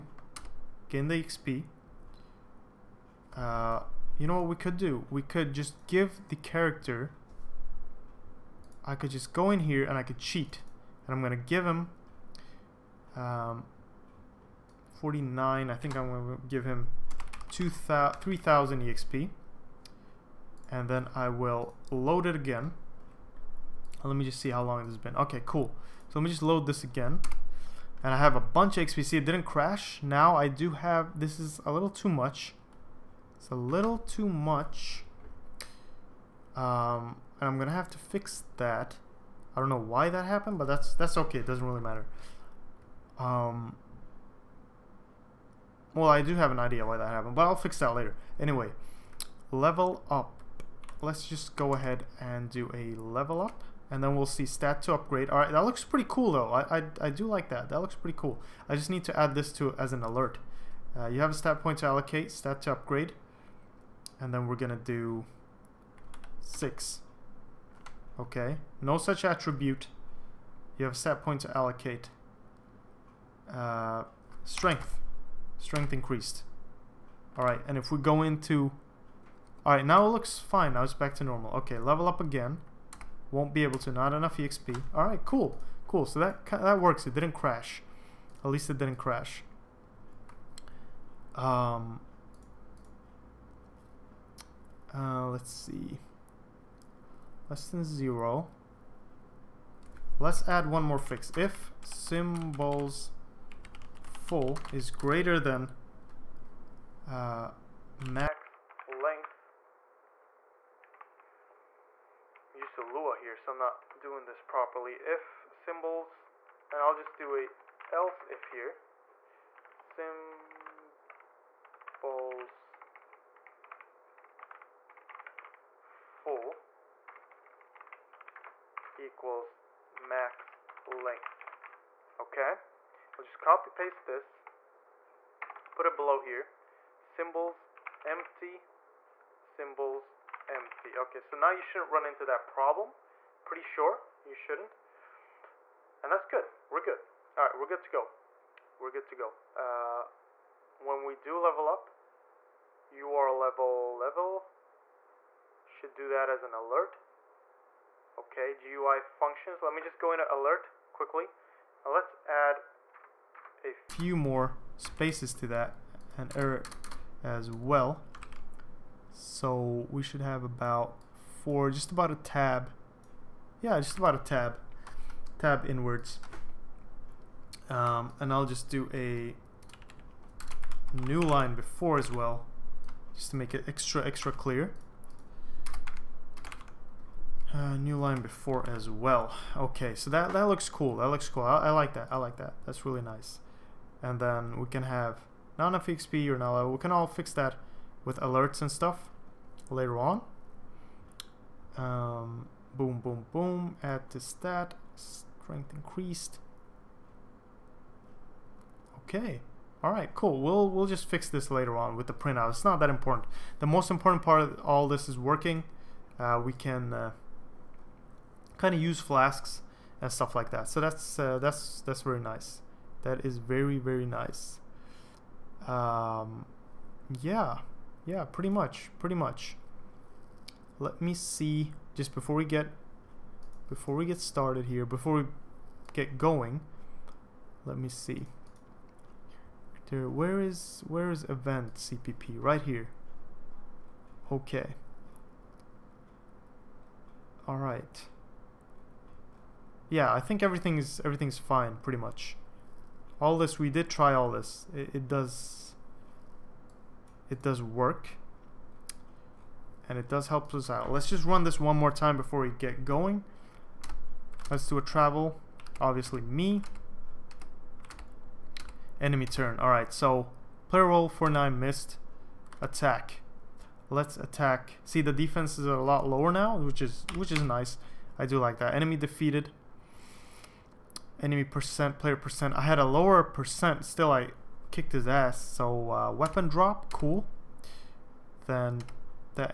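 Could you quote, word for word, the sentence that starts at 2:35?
Should do that as an alert.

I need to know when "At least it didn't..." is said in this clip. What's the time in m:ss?
1:28.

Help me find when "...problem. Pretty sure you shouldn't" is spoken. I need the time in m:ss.
2:22.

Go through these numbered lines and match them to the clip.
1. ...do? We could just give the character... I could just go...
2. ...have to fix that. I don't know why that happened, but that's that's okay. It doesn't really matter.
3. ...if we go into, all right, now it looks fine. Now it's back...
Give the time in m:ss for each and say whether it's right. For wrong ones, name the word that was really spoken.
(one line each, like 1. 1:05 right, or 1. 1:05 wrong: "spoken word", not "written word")
1. 0:04 right
2. 0:37 right
3. 1:17 right.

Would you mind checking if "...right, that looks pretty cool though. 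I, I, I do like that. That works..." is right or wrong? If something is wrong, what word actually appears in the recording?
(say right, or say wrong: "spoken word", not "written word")
wrong: "looks", not "works".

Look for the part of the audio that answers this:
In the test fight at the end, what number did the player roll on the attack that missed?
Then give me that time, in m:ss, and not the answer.
4:31.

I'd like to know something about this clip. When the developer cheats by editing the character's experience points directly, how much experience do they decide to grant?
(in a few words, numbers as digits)
3,000.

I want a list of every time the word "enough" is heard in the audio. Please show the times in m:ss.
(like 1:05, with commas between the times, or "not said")
1:24, 3:15.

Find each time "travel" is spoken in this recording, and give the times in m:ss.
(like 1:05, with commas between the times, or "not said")
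4:24.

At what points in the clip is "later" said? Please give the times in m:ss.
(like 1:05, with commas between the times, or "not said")
0:47, 3:19, 3:31.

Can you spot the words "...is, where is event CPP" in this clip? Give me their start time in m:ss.
4:00.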